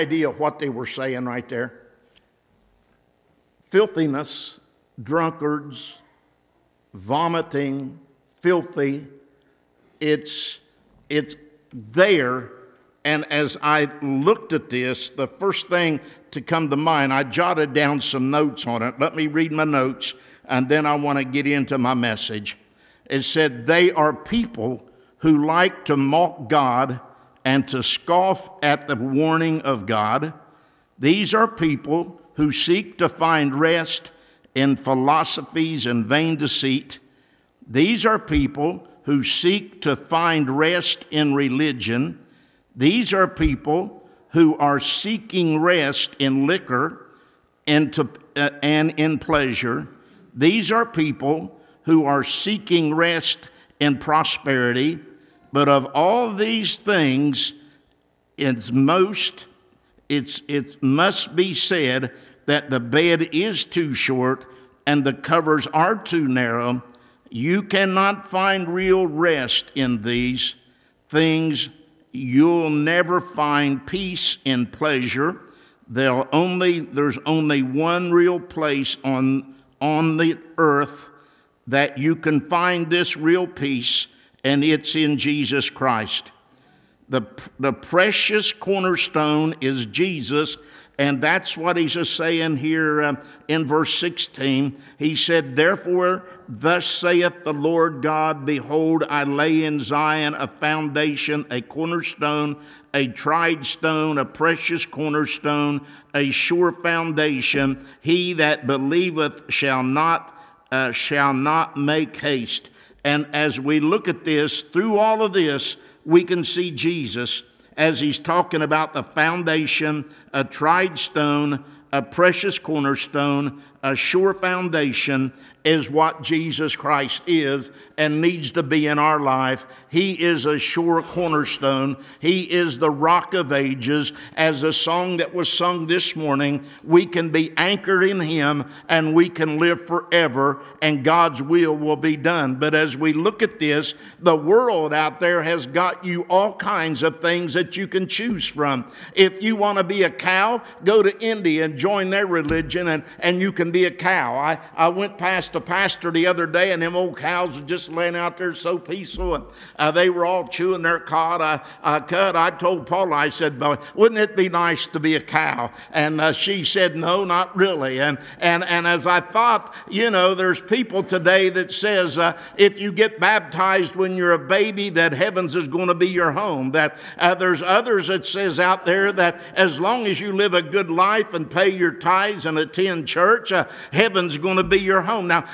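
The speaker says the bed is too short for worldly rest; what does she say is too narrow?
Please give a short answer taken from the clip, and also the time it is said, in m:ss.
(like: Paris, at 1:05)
The covers, at 1:05.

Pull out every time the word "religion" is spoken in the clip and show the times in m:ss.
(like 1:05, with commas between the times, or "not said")
0:41, 2:32.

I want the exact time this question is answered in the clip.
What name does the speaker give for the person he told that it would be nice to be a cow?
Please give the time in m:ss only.
2:42.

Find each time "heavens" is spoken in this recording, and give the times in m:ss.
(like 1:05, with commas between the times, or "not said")
2:55, 3:03.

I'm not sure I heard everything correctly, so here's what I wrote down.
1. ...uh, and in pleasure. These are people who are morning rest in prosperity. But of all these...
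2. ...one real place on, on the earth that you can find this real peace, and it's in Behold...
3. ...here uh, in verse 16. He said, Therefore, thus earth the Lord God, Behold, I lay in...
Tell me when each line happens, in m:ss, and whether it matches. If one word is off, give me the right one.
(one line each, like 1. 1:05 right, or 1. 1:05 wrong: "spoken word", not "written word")
1. 0:48 wrong: "seeking", not "morning"
2. 1:17 wrong: "Jesus", not "Behold"
3. 1:32 wrong: "saith", not "earth".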